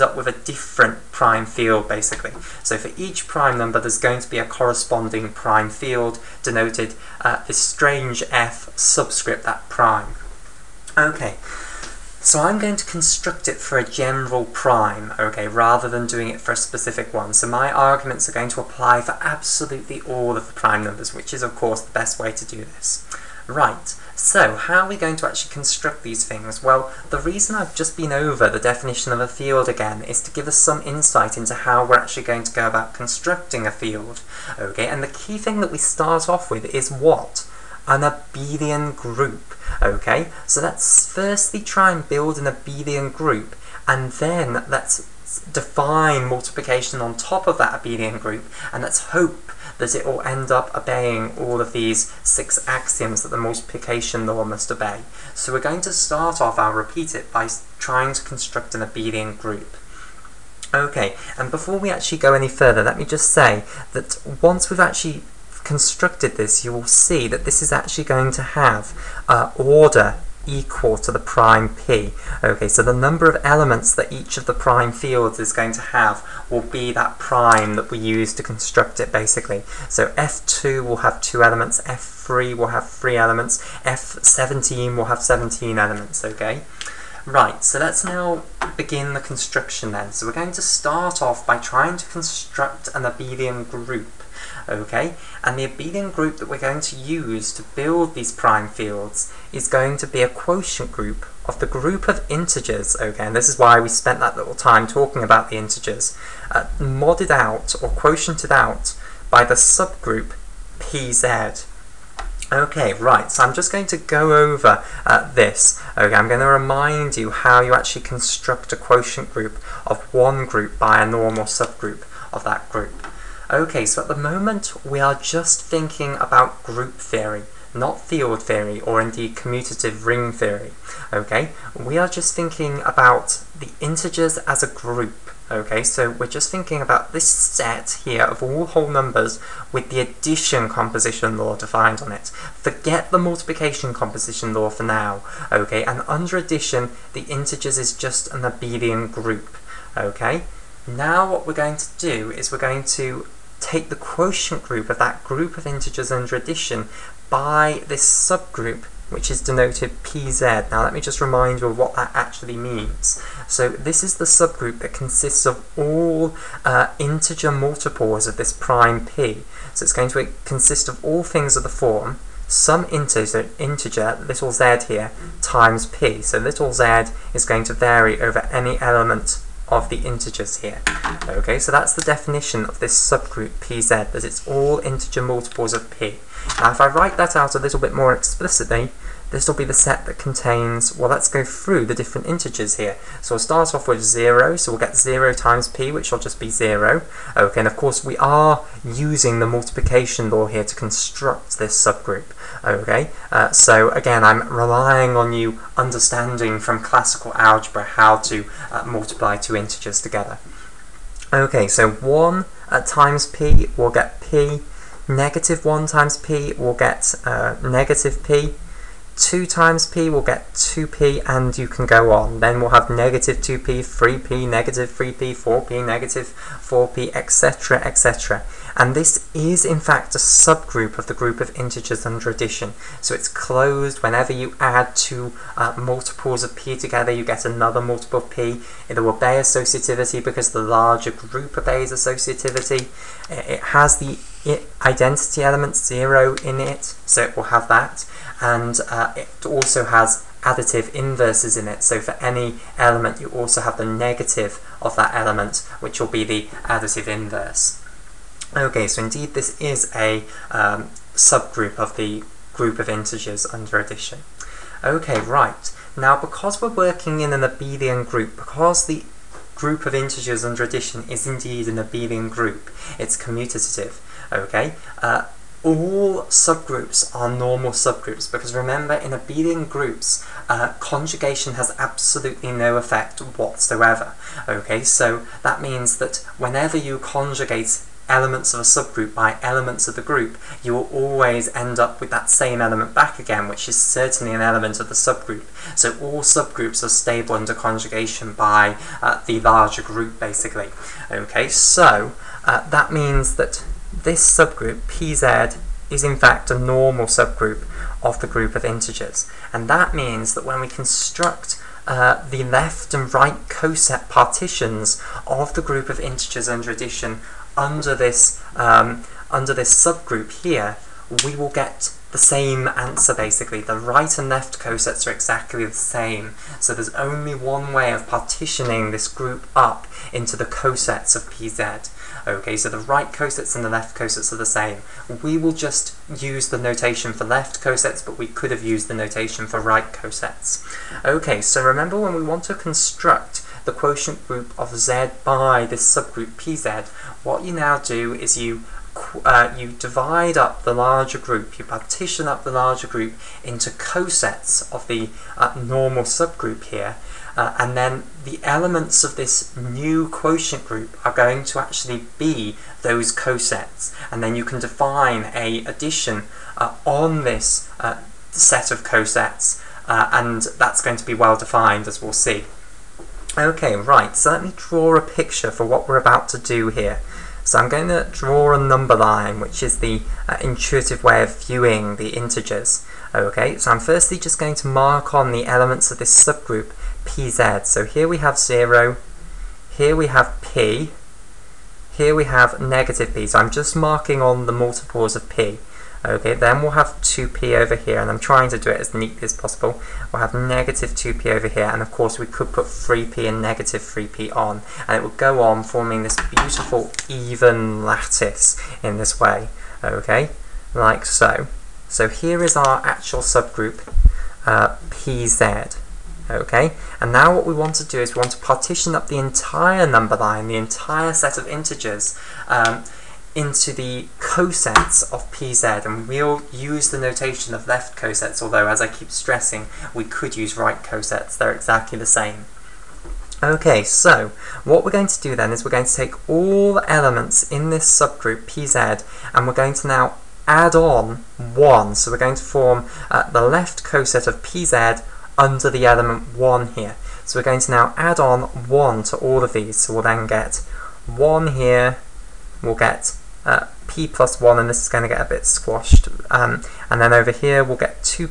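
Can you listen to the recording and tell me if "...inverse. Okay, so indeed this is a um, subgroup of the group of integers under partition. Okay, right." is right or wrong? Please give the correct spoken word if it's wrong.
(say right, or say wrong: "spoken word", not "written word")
wrong: "addition", not "partition".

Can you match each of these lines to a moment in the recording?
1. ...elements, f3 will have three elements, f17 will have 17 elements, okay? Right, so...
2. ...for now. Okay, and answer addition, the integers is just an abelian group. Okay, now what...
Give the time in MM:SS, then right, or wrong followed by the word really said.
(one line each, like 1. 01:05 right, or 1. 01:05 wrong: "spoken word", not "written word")
1. 01:21 right
2. 02:24 wrong: "under", not "answer".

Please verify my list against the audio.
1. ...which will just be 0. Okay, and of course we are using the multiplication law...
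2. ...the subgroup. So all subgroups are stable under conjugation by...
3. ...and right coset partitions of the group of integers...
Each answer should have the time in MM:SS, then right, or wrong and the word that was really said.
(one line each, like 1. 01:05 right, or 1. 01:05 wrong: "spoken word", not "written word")
1. 03:15 right
2. 04:54 right
3. 05:12 right.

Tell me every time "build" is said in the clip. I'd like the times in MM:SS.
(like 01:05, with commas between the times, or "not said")
00:42, 01:37.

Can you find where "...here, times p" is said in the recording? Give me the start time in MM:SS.
02:54.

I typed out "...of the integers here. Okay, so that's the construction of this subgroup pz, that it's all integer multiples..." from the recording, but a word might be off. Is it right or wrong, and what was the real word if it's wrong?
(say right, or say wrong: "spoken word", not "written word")
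wrong: "definition", not "construction".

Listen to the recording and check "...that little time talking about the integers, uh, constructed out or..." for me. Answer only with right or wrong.
wrong.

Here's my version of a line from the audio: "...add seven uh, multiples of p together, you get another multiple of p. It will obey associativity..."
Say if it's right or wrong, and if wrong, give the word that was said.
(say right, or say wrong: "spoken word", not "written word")
wrong: "two", not "seven".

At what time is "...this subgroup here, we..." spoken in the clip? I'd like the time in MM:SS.
05:19.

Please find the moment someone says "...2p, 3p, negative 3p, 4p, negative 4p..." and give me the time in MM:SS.
03:43.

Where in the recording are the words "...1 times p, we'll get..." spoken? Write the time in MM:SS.
03:35.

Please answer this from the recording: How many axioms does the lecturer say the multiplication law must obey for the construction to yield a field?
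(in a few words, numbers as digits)
6.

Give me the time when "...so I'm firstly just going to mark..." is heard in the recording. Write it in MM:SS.
06:23.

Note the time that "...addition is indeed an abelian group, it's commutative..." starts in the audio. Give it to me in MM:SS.
04:30.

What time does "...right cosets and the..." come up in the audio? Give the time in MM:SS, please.
05:32.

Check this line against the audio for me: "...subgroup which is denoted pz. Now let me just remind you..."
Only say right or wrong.
right.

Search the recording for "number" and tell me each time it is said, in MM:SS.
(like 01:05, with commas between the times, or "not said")
00:03, 00:20, 01:12, 02:18, 06:18, 06:59.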